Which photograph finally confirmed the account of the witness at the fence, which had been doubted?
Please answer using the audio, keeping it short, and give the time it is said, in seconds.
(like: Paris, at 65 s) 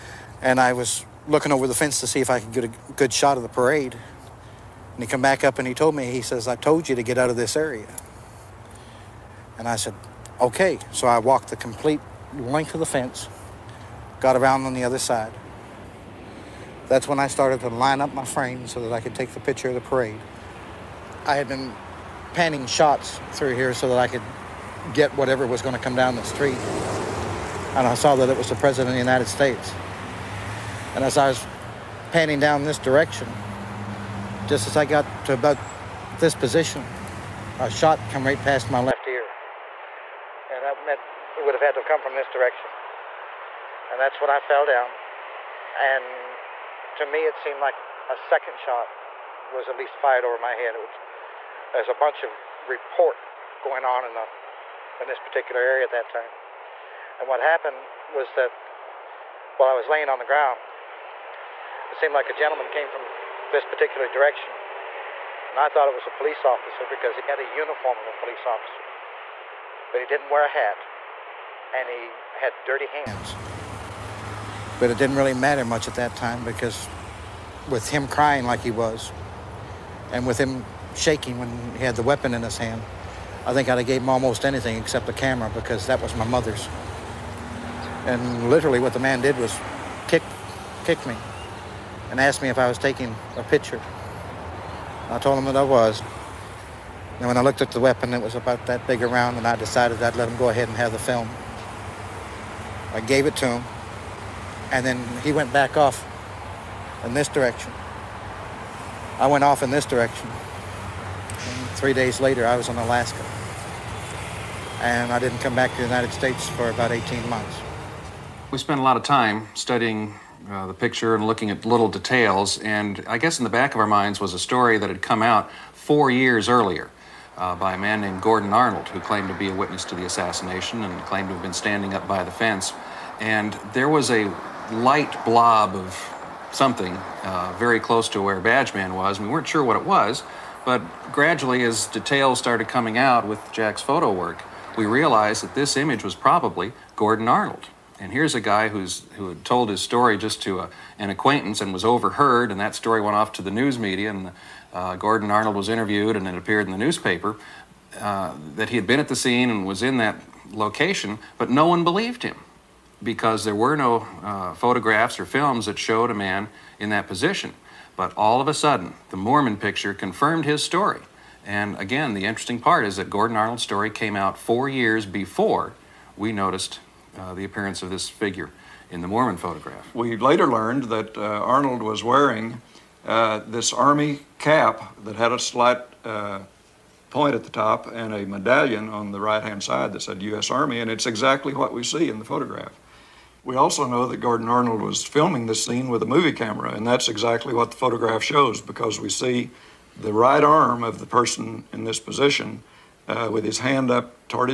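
The Moorman picture, at 169 s.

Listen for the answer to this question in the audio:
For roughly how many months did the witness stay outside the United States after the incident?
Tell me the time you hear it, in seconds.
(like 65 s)
116 s.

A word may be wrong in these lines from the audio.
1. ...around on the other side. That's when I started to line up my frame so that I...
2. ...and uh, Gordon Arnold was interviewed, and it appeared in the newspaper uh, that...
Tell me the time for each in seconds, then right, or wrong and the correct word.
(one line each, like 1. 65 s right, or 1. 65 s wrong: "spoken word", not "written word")
1. 14 s right
2. 154 s right.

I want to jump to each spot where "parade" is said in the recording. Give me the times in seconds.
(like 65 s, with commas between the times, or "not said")
3 s, 19 s.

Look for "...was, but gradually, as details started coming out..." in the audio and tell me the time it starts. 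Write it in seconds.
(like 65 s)
139 s.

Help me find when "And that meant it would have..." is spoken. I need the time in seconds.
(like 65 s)
40 s.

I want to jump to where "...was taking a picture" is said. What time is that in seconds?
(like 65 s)
92 s.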